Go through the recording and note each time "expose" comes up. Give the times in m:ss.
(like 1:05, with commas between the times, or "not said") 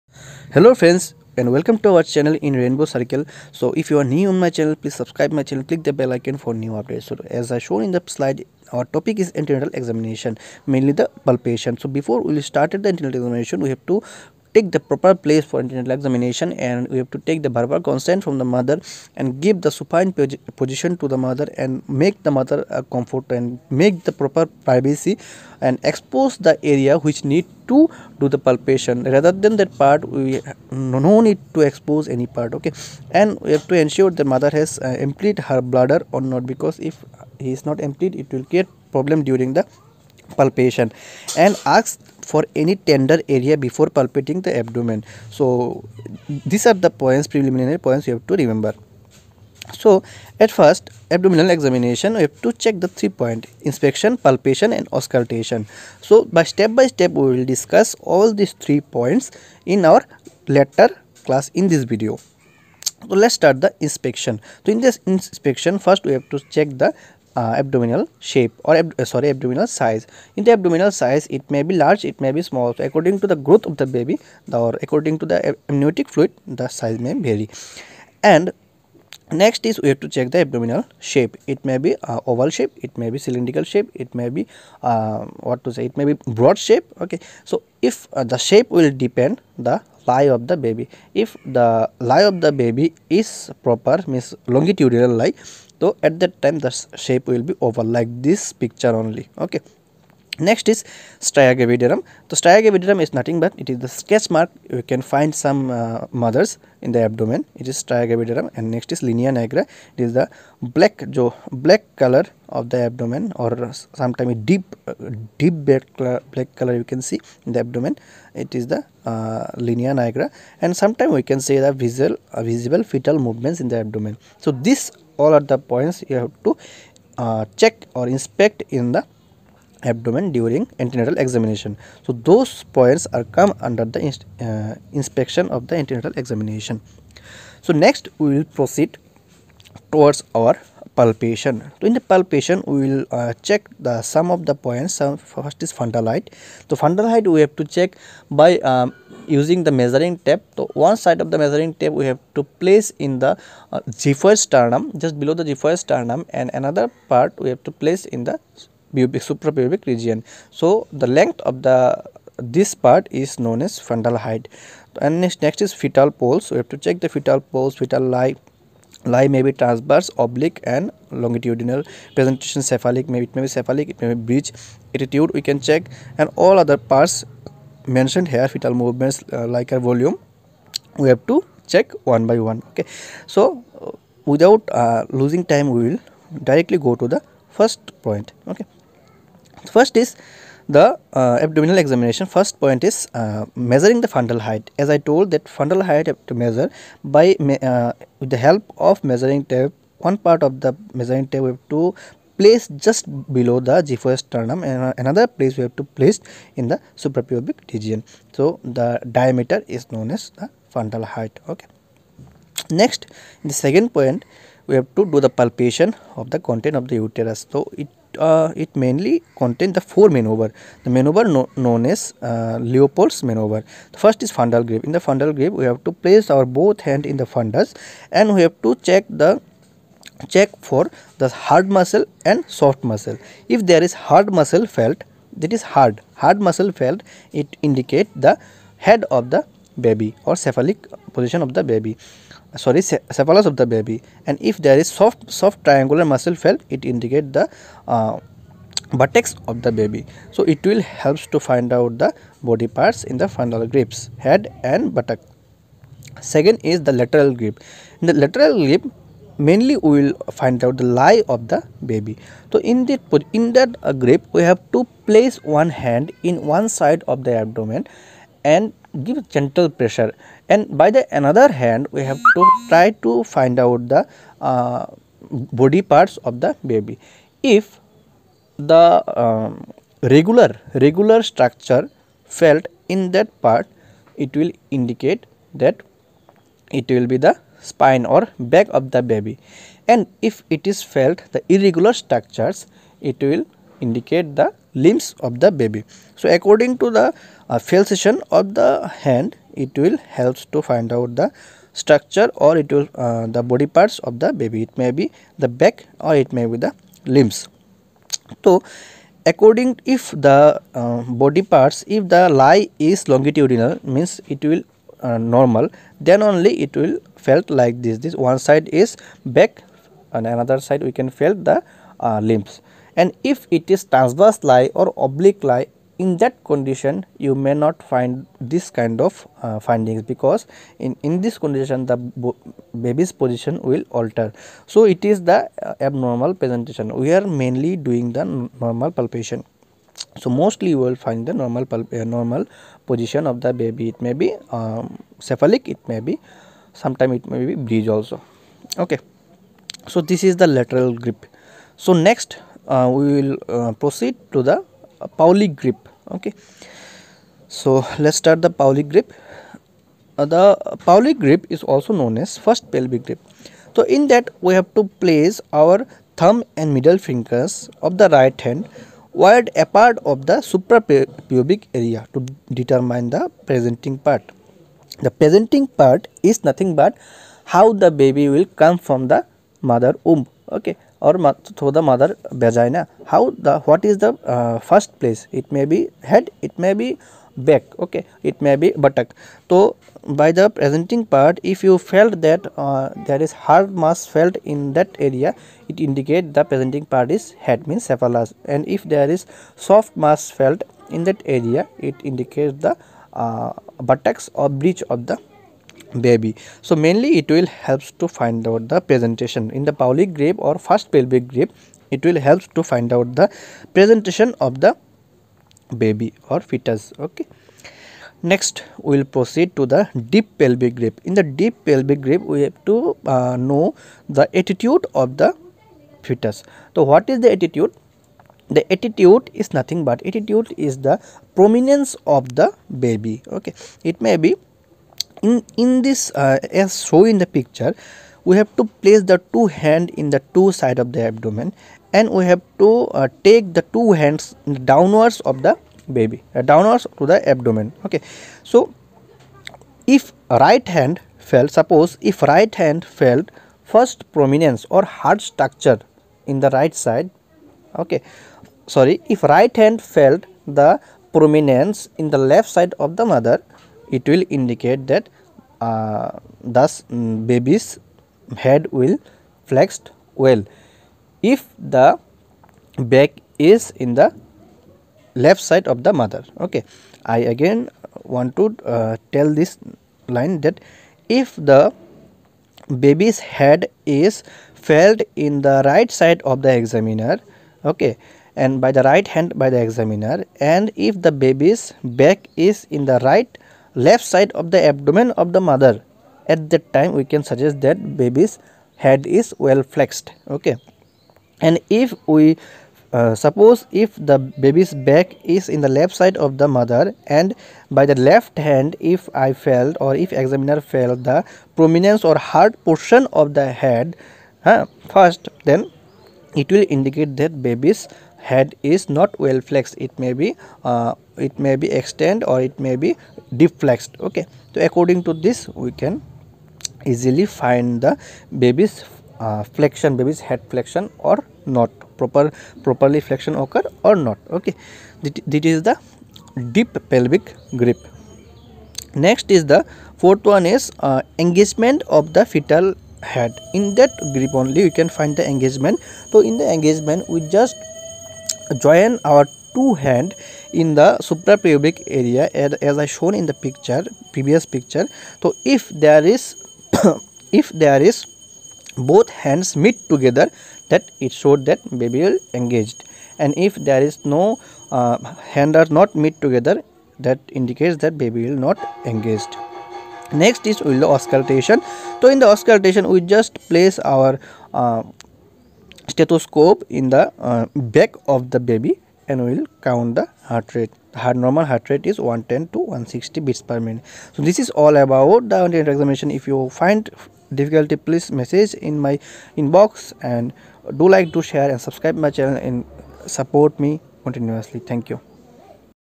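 0:25, 0:31.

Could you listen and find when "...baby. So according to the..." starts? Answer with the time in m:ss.
4:55.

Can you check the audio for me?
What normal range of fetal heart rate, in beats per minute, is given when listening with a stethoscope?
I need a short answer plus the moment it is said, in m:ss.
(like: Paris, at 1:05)
110 to 160, at 9:41.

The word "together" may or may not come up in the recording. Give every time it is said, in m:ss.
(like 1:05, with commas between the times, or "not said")
9:19, 9:26.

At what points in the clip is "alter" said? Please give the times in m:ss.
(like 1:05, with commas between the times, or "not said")
5:34.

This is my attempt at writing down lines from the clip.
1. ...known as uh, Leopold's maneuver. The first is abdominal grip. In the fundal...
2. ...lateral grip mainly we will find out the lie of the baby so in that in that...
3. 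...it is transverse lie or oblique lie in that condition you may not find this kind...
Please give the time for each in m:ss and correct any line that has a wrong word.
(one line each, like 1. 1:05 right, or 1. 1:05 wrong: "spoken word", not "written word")
1. 3:41 wrong: "fundal", not "abdominal"
2. 4:18 right
3. 5:23 right.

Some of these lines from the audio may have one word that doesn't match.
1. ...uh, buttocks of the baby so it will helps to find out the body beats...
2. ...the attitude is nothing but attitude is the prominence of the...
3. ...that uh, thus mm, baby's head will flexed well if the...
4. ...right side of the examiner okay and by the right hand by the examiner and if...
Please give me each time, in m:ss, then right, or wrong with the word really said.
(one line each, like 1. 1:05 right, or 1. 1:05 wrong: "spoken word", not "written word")
1. 4:07 wrong: "parts", not "beats"
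2. 7:08 right
3. 7:44 right
4. 8:05 right.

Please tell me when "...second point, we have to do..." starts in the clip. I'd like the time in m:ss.
3:33.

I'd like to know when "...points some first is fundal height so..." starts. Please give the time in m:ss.
2:24.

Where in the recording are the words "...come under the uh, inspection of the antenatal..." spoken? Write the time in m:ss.
2:13.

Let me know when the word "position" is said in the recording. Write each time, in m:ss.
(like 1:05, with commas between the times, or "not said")
0:20, 4:01, 5:33, 5:42.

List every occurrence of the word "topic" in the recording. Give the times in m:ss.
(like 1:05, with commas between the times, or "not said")
0:08.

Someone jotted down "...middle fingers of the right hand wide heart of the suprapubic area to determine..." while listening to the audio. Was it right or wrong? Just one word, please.
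wrong.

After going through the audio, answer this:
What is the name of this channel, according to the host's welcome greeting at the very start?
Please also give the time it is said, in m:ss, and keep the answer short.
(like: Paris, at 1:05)
Rainbow Circle, at 0:02.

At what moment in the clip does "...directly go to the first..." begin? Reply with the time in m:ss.
3:06.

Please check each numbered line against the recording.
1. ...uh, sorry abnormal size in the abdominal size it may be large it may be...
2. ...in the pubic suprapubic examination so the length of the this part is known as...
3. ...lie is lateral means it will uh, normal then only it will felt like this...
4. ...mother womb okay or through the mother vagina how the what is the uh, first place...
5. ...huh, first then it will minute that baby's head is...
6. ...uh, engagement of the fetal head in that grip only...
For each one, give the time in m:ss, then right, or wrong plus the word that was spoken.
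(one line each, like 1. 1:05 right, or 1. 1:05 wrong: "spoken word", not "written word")
1. 1:08 wrong: "abdominal", not "abnormal"
2. 2:38 wrong: "region", not "examination"
3. 5:12 wrong: "longitudinal", not "lateral"
4. 6:19 right
5. 8:34 wrong: "indicate", not "minute"
6. 9:00 right.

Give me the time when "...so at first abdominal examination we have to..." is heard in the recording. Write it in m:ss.
0:49.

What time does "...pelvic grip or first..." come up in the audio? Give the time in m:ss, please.
6:49.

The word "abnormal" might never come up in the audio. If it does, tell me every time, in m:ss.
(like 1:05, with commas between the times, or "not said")
5:35.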